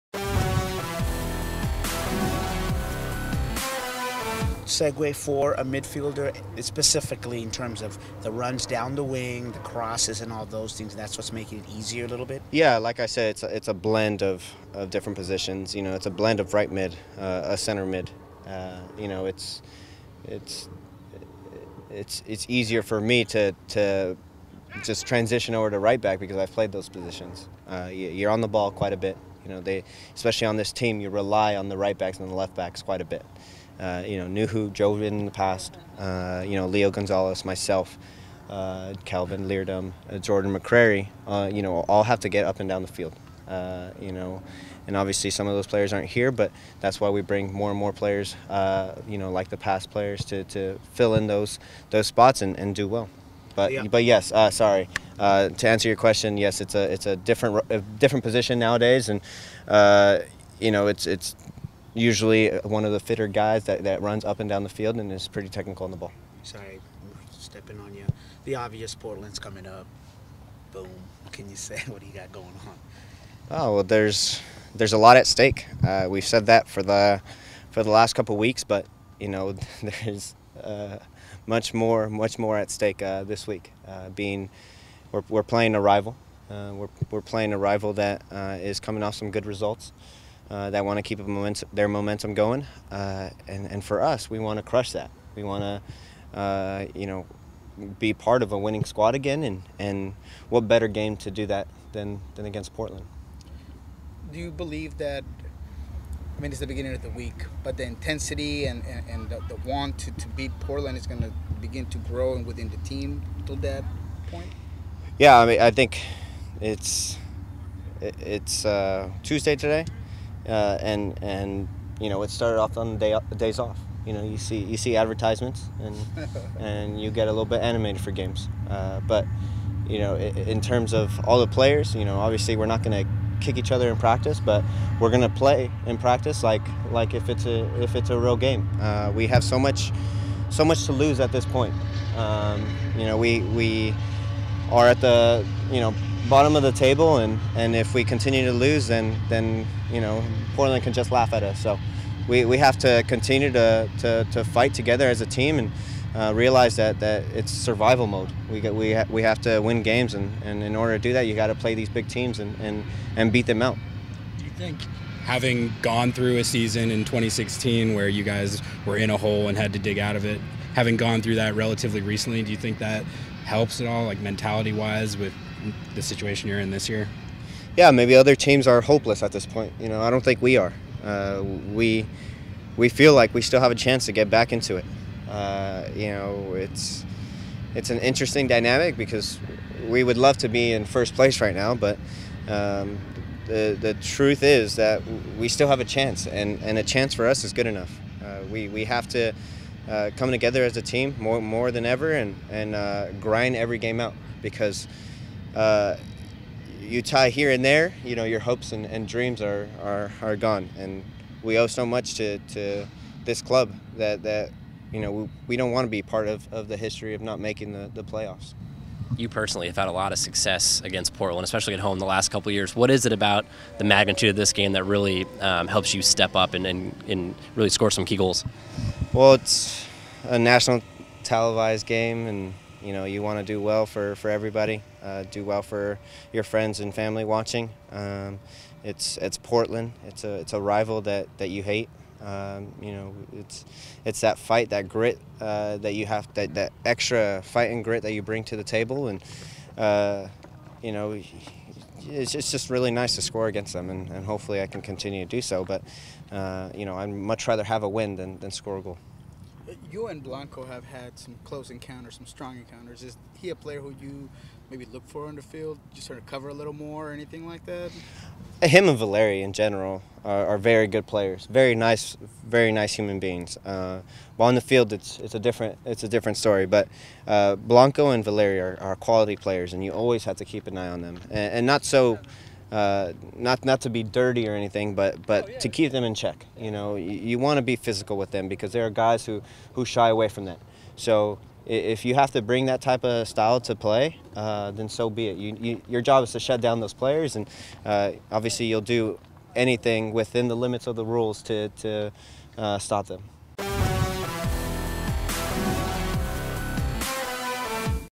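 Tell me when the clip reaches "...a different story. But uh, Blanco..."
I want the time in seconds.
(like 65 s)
276 s.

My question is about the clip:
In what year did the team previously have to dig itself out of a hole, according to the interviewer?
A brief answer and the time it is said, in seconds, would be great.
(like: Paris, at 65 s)
2016, at 167 s.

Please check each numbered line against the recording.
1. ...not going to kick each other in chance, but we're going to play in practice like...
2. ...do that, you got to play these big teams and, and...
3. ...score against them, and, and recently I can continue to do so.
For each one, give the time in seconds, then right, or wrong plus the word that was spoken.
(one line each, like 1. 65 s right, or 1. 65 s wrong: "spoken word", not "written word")
1. 132 s wrong: "practice", not "chance"
2. 161 s right
3. 253 s wrong: "hopefully", not "recently".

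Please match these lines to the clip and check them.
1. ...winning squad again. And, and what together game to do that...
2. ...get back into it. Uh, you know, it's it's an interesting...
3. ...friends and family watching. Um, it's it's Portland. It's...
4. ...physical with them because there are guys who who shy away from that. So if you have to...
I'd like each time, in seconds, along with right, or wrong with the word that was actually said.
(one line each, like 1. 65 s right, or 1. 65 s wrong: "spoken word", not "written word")
1. 98 s wrong: "better", not "together"
2. 184 s right
3. 236 s right
4. 287 s right.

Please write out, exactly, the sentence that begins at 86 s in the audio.
Uh, we're, we're playing a rival that is coming off some good results.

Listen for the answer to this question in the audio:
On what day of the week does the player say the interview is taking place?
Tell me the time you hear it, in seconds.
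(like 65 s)
119 s.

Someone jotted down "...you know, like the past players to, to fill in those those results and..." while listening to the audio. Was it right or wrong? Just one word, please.
wrong.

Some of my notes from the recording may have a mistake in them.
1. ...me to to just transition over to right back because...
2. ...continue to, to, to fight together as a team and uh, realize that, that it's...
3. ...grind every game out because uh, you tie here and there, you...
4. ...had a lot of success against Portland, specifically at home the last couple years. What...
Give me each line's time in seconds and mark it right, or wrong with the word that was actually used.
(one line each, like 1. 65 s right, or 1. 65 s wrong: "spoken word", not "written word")
1. 22 s right
2. 153 s right
3. 203 s right
4. 219 s wrong: "especially", not "specifically".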